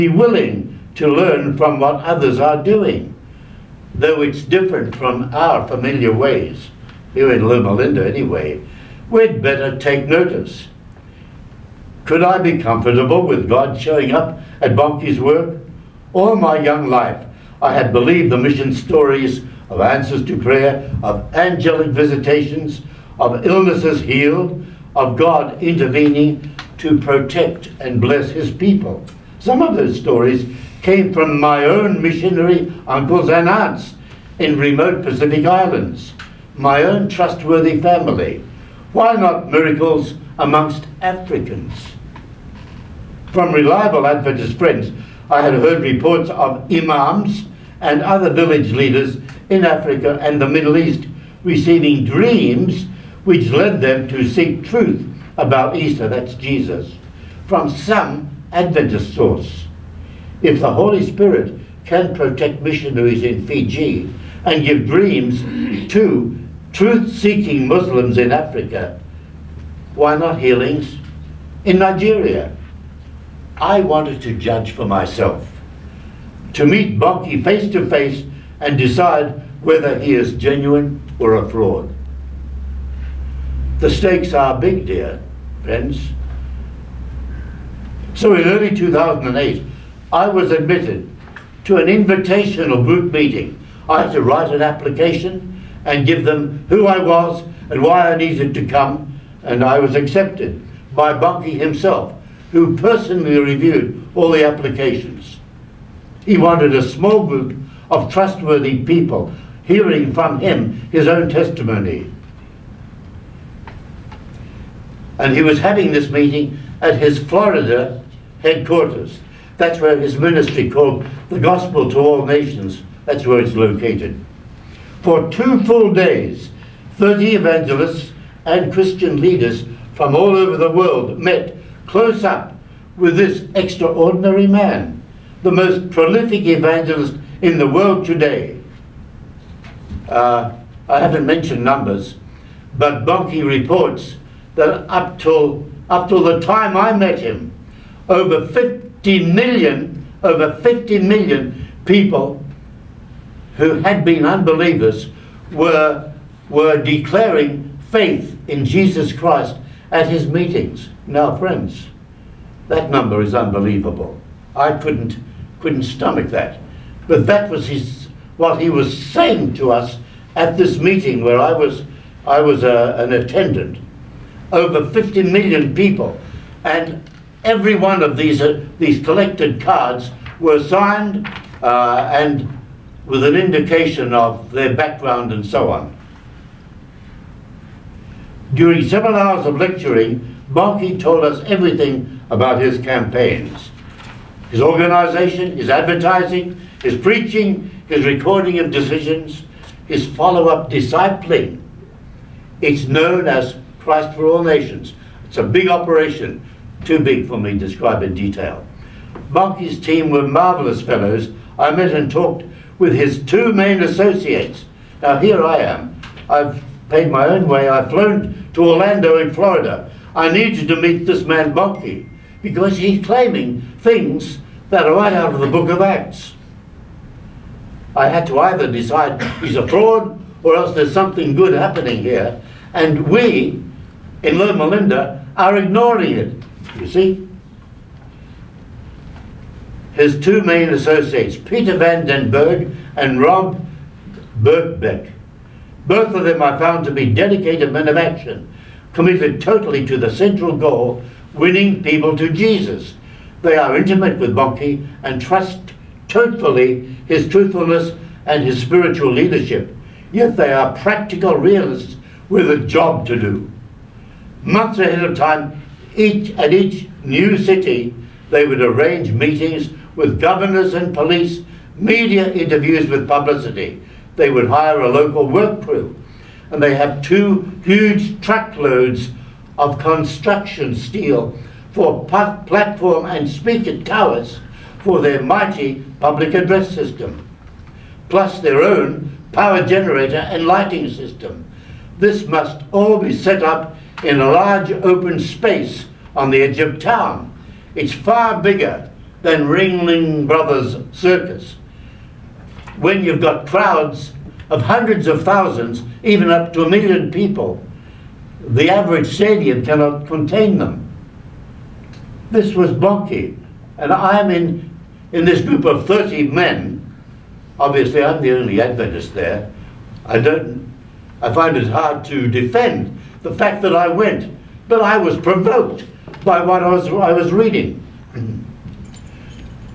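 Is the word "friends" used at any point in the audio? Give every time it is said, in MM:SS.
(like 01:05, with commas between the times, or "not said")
00:44, 01:25, 02:41.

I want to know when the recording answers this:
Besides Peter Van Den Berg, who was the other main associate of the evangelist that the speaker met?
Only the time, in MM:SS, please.
04:03.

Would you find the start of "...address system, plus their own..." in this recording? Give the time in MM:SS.
04:46.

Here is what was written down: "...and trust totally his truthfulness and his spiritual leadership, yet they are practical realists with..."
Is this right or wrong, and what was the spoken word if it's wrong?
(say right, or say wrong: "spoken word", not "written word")
right.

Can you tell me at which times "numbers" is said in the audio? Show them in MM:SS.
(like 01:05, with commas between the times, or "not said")
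02:21, 02:42.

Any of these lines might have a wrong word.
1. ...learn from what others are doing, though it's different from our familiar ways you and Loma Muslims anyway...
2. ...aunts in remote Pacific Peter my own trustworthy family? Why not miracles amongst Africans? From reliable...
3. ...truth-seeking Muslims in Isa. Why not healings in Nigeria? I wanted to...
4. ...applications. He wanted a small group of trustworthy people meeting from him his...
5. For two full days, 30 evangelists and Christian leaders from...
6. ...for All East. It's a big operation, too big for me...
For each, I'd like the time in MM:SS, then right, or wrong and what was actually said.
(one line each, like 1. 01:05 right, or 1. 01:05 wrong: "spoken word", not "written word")
1. 00:01 wrong: "Linda", not "Muslims"
2. 00:33 wrong: "Islands", not "Peter"
3. 01:06 wrong: "Africa", not "Isa"
4. 01:44 wrong: "hearing", not "meeting"
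5. 02:05 right
6. 03:24 wrong: "Nations", not "East".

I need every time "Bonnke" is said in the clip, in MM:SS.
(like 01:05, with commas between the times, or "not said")
00:14, 01:16, 01:41, 02:23, 03:10, 03:29, 03:41, 05:12.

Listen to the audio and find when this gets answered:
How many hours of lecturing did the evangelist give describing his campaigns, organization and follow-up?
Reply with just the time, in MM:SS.
03:08.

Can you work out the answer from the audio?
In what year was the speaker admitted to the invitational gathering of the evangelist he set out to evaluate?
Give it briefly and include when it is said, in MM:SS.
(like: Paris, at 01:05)
2008, at 01:28.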